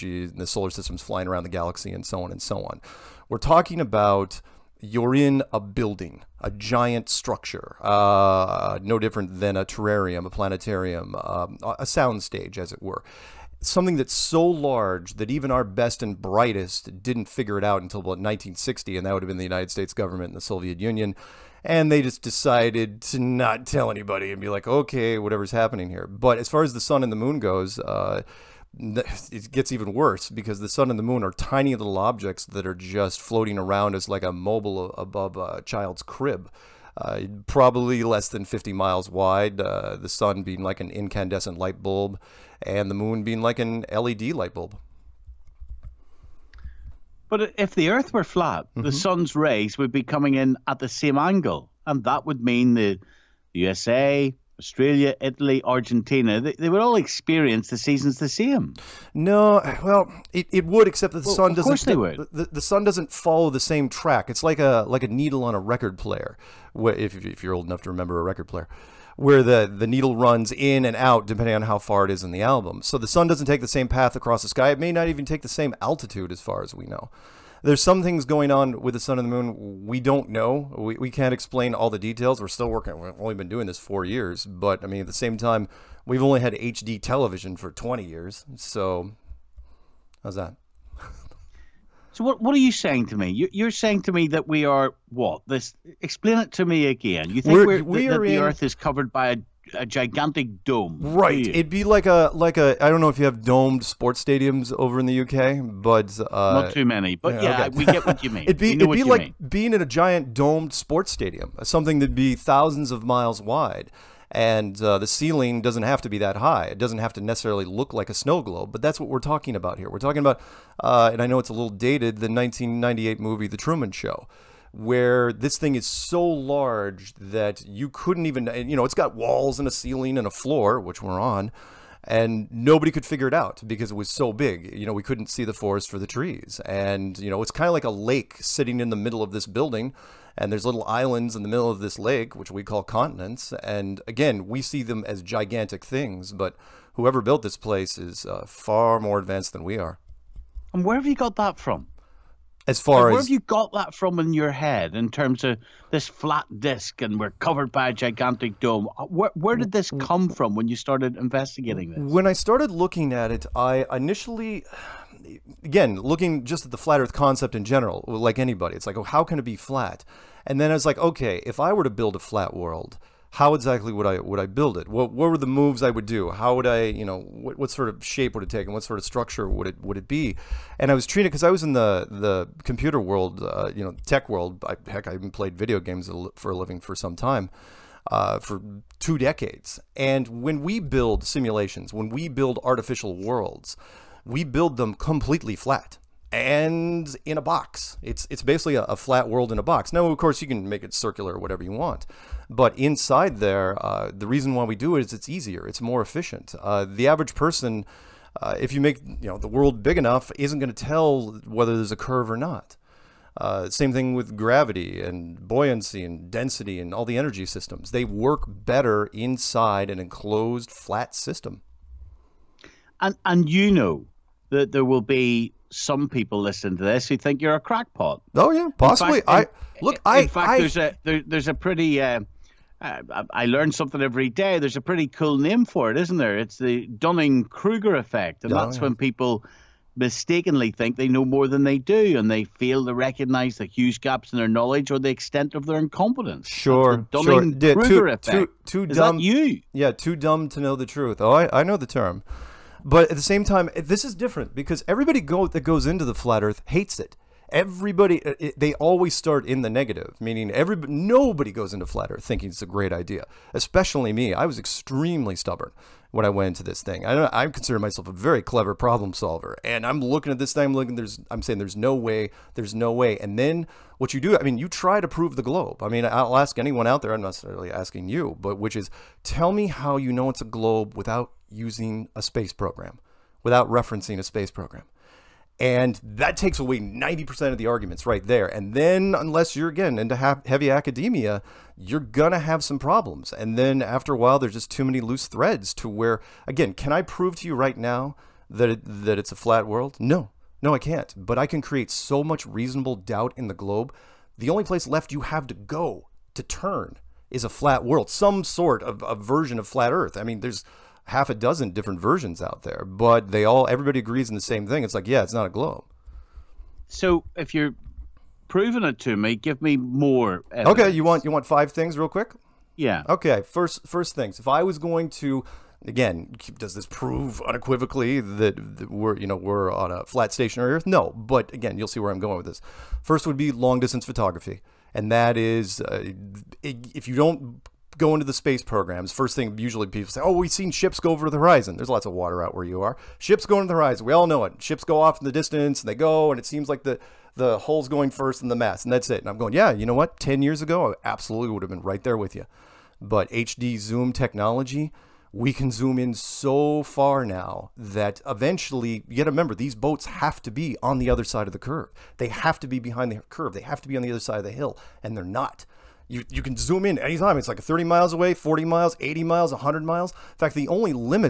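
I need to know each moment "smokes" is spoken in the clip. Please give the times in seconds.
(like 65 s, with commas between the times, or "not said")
not said.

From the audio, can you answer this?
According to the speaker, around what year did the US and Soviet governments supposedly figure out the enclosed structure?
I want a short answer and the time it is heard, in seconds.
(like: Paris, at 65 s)
1960, at 18 s.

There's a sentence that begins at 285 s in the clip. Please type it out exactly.
And that takes away 90% of the arguments right there.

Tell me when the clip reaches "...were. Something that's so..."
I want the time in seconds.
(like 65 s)
12 s.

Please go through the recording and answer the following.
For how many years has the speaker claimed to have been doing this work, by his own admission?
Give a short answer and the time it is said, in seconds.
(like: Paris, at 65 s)
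4 years, at 83 s.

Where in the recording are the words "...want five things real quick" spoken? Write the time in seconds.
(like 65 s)
321 s.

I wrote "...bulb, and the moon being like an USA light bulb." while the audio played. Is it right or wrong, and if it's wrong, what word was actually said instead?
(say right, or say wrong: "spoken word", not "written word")
wrong: "LED", not "USA".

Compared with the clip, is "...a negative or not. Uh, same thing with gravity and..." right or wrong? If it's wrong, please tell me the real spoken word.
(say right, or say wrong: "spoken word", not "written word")
wrong: "curve", not "negative".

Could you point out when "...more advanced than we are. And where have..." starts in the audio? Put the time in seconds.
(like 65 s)
148 s.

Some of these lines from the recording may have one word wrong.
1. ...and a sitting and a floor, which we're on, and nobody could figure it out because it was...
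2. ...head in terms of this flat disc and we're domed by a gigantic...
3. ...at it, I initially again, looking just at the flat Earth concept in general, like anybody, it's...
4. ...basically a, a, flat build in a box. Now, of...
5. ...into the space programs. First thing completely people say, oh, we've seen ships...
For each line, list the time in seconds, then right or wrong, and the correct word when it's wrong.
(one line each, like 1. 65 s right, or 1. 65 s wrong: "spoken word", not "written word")
1. 129 s wrong: "ceiling", not "sitting"
2. 154 s wrong: "covered", not "domed"
3. 163 s right
4. 198 s wrong: "world", not "build"
5. 338 s wrong: "usually", not "completely".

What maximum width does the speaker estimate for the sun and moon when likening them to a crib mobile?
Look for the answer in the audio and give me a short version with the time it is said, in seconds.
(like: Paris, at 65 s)
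50 miles, at 38 s.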